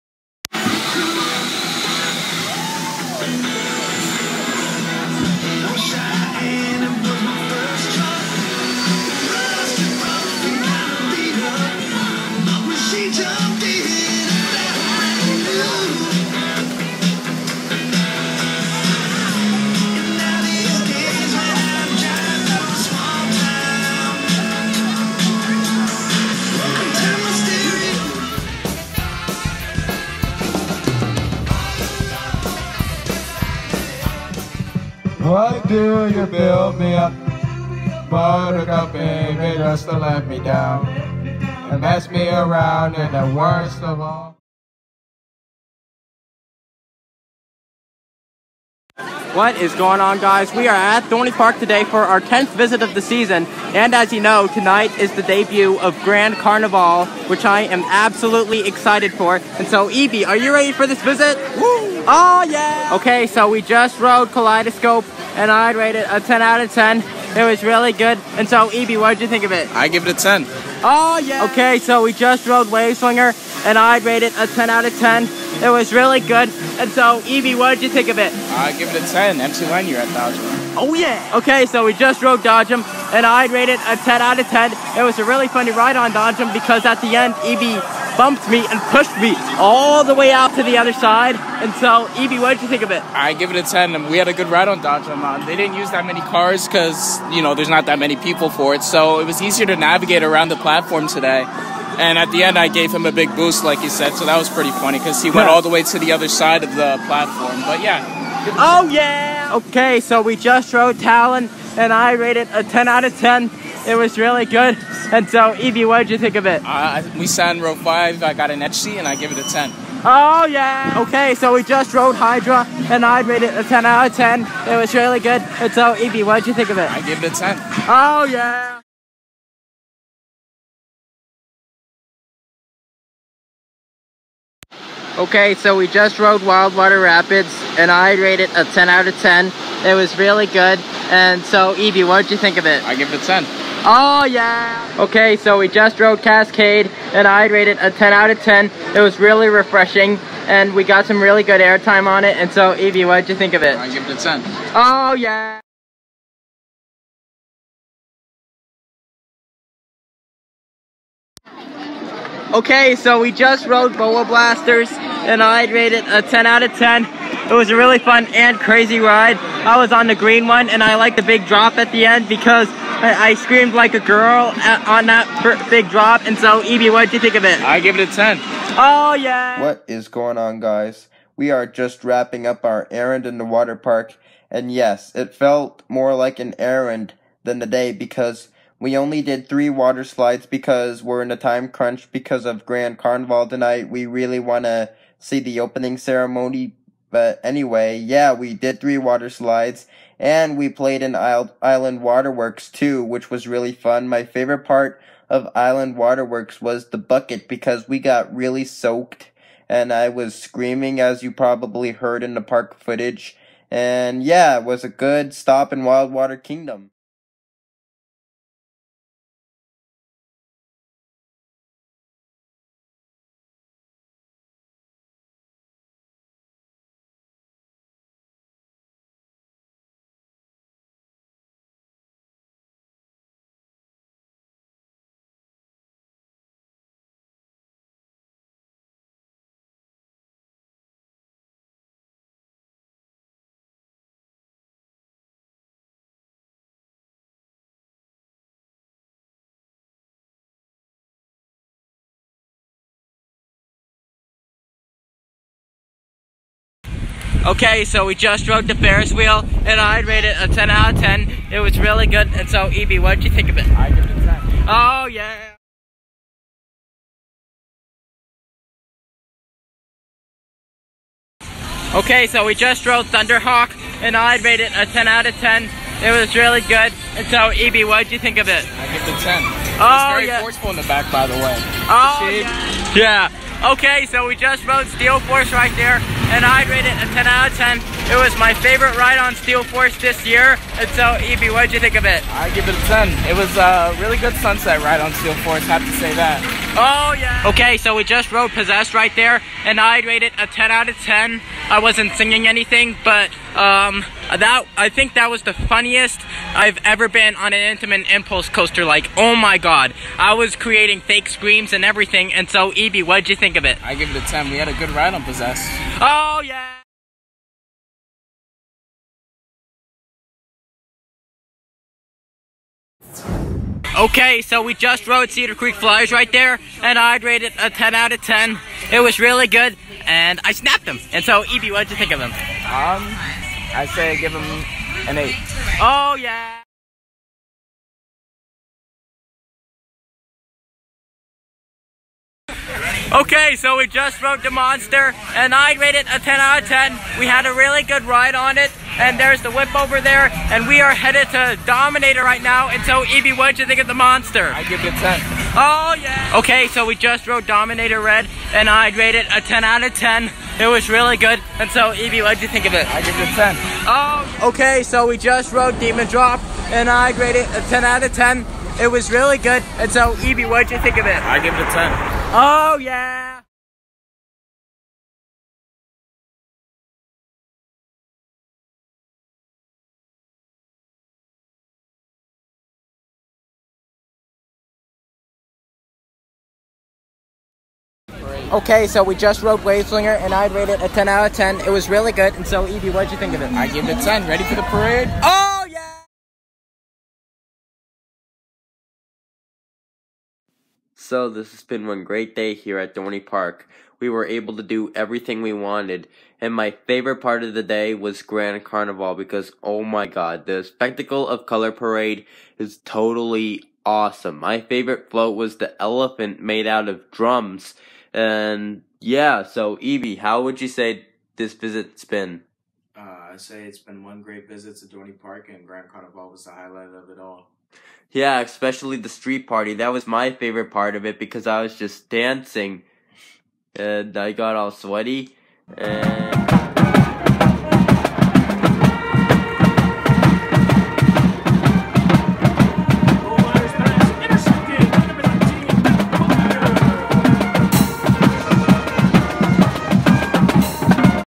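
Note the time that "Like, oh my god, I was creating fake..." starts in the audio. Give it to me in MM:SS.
05:08.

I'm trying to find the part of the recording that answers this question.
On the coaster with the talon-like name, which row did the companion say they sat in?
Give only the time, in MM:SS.
01:57.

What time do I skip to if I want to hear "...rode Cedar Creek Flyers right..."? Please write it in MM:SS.
05:25.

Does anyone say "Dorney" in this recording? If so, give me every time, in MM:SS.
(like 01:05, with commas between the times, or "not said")
00:51, 06:42, 07:04.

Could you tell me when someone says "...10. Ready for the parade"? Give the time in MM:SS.
06:34.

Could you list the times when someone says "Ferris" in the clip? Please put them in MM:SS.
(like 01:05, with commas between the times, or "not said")
04:18.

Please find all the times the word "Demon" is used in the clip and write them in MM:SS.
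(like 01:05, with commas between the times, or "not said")
06:05.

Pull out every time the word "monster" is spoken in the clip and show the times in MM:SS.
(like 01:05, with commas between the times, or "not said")
05:44, 05:53.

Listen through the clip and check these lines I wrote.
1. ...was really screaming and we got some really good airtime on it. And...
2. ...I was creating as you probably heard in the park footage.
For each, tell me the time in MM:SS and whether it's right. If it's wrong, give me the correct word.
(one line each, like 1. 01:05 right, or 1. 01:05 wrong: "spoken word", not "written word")
1. 02:28 wrong: "refreshing", not "screaming"
2. 03:29 wrong: "screaming", not "creating".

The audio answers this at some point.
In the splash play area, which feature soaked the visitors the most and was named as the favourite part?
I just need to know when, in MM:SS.
03:26.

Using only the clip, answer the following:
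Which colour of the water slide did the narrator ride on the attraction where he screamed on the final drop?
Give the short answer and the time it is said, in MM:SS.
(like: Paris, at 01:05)
Green, at 02:50.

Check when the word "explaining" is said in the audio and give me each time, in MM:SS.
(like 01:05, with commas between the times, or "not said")
not said.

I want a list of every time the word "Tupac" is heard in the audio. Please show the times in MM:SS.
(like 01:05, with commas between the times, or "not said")
not said.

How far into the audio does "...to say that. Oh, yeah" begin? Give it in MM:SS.
04:55.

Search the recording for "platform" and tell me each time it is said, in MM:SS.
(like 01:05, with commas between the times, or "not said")
01:40, 01:47.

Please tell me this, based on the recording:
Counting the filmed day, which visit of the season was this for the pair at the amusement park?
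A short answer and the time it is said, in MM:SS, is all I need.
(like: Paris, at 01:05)
10th, at 00:52.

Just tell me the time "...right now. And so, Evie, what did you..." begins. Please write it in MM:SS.
05:52.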